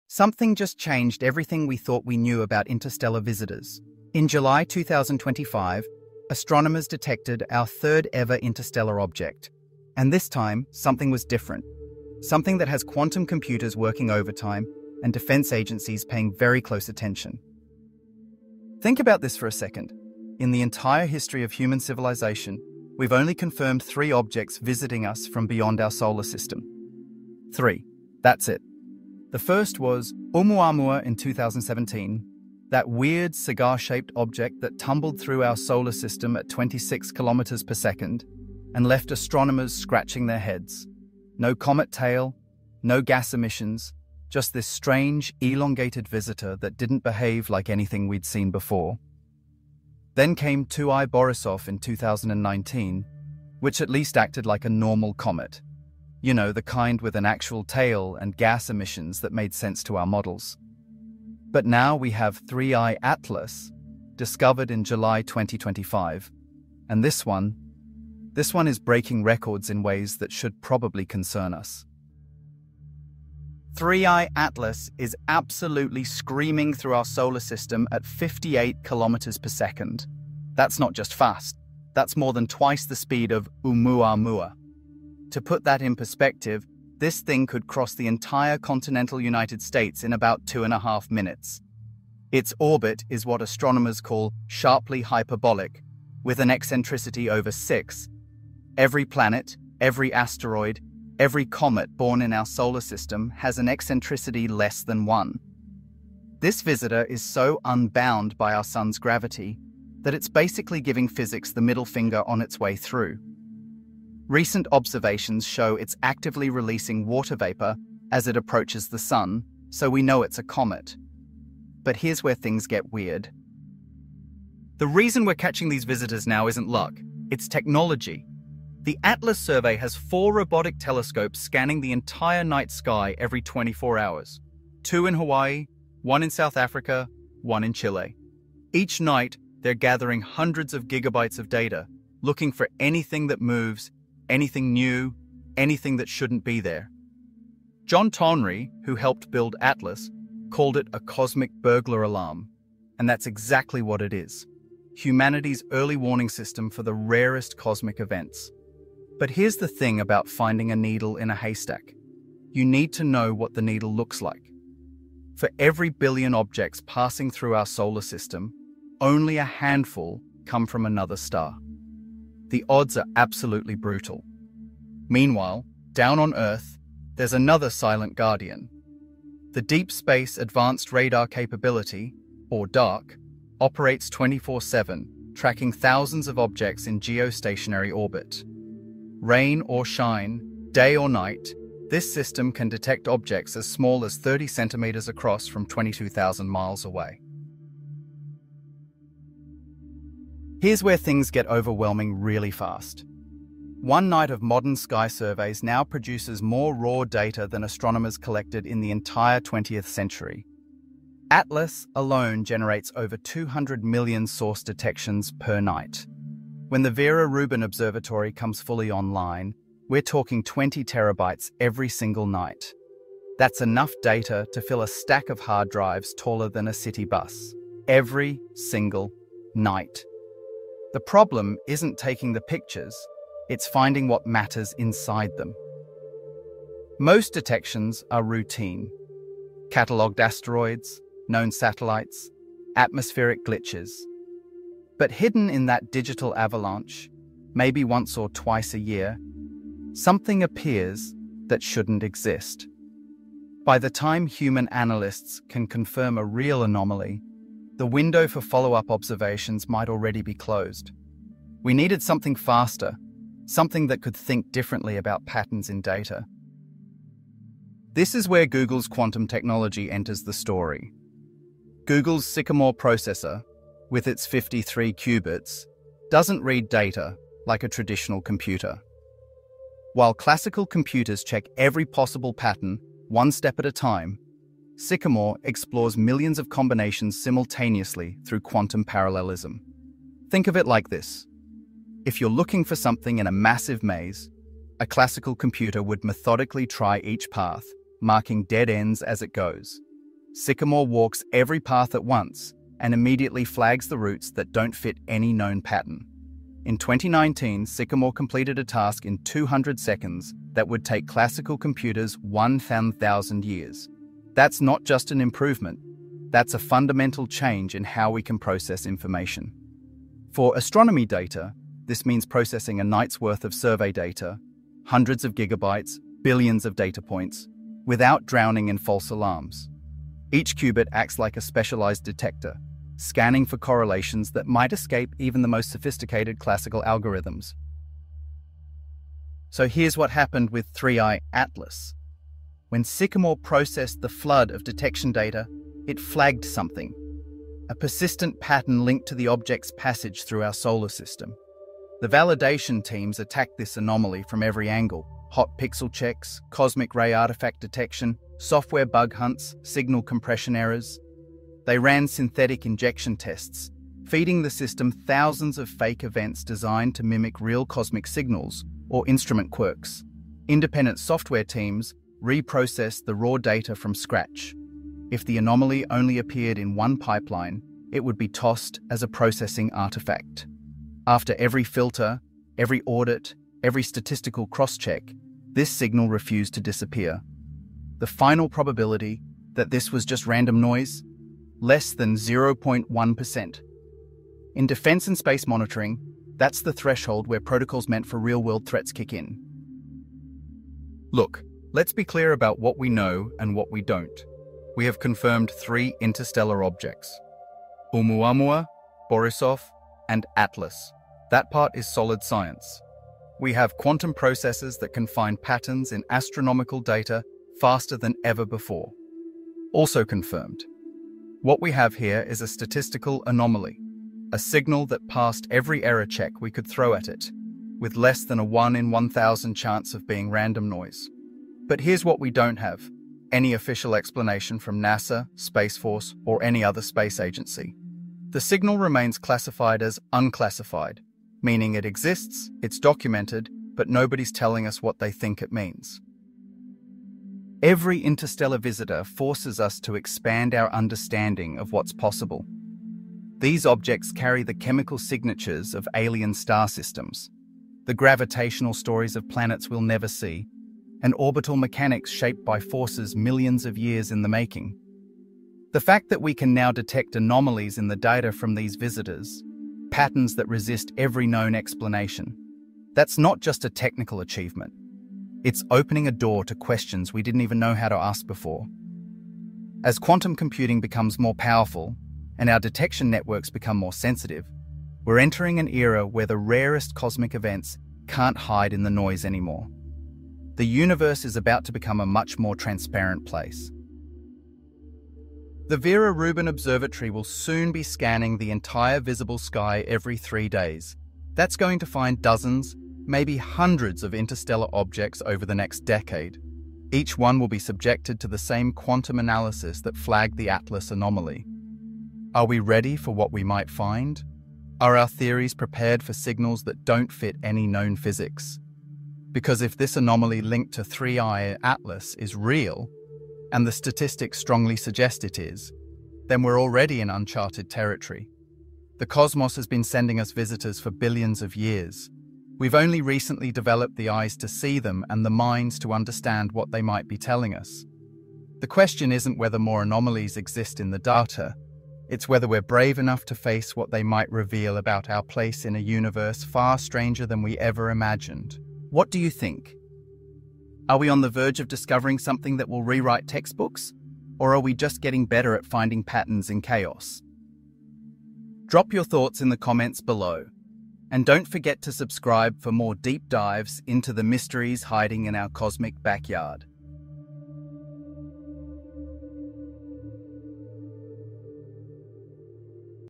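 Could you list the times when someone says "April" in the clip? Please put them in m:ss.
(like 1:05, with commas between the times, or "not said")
not said.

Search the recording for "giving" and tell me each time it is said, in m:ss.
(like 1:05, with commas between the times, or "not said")
1:50.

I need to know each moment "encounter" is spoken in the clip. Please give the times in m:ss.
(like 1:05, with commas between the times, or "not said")
not said.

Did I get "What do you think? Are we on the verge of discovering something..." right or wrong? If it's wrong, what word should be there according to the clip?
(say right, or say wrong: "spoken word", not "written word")
right.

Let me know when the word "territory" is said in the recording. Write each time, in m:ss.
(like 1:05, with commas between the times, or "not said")
8:47.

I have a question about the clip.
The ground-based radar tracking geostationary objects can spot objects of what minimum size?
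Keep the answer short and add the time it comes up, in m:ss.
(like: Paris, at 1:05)
30 cm, at 3:14.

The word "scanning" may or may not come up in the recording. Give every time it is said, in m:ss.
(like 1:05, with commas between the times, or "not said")
2:11, 5:32, 8:17.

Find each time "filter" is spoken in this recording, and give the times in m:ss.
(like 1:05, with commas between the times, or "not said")
6:21.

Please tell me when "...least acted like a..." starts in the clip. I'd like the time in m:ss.
0:53.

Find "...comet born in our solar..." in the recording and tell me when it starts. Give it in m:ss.
1:41.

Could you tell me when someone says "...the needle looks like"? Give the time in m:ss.
2:43.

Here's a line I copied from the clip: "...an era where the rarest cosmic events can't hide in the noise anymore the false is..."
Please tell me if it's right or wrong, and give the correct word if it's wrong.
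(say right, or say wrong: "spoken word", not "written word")
wrong: "universe", not "false".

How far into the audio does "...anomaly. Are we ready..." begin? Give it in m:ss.
8:30.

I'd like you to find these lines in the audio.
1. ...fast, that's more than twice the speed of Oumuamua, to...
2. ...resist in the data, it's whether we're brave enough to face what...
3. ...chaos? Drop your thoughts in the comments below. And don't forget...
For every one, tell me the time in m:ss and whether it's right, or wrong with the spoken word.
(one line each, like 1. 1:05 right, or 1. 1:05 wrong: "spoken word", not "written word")
1. 1:21 right
2. 9:00 wrong: "exist", not "resist"
3. 9:16 right.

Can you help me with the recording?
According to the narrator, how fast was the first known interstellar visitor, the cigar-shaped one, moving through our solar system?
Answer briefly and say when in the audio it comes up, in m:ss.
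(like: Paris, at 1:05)
26 km/s, at 0:36.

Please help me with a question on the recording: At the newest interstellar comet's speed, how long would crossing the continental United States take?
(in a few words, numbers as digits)
about two and a half minutes.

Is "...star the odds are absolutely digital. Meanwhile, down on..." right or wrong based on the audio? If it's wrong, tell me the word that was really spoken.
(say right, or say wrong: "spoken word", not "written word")
wrong: "brutal", not "digital".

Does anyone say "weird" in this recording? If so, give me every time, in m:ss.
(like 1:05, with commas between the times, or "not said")
0:32, 2:02.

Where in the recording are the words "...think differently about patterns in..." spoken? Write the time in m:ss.
4:24.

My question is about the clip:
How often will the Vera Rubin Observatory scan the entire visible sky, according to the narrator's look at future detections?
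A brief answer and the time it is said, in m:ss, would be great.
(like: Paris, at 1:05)
every 3 days, at 8:19.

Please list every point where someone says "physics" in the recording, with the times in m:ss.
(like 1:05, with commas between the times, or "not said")
1:51, 8:37.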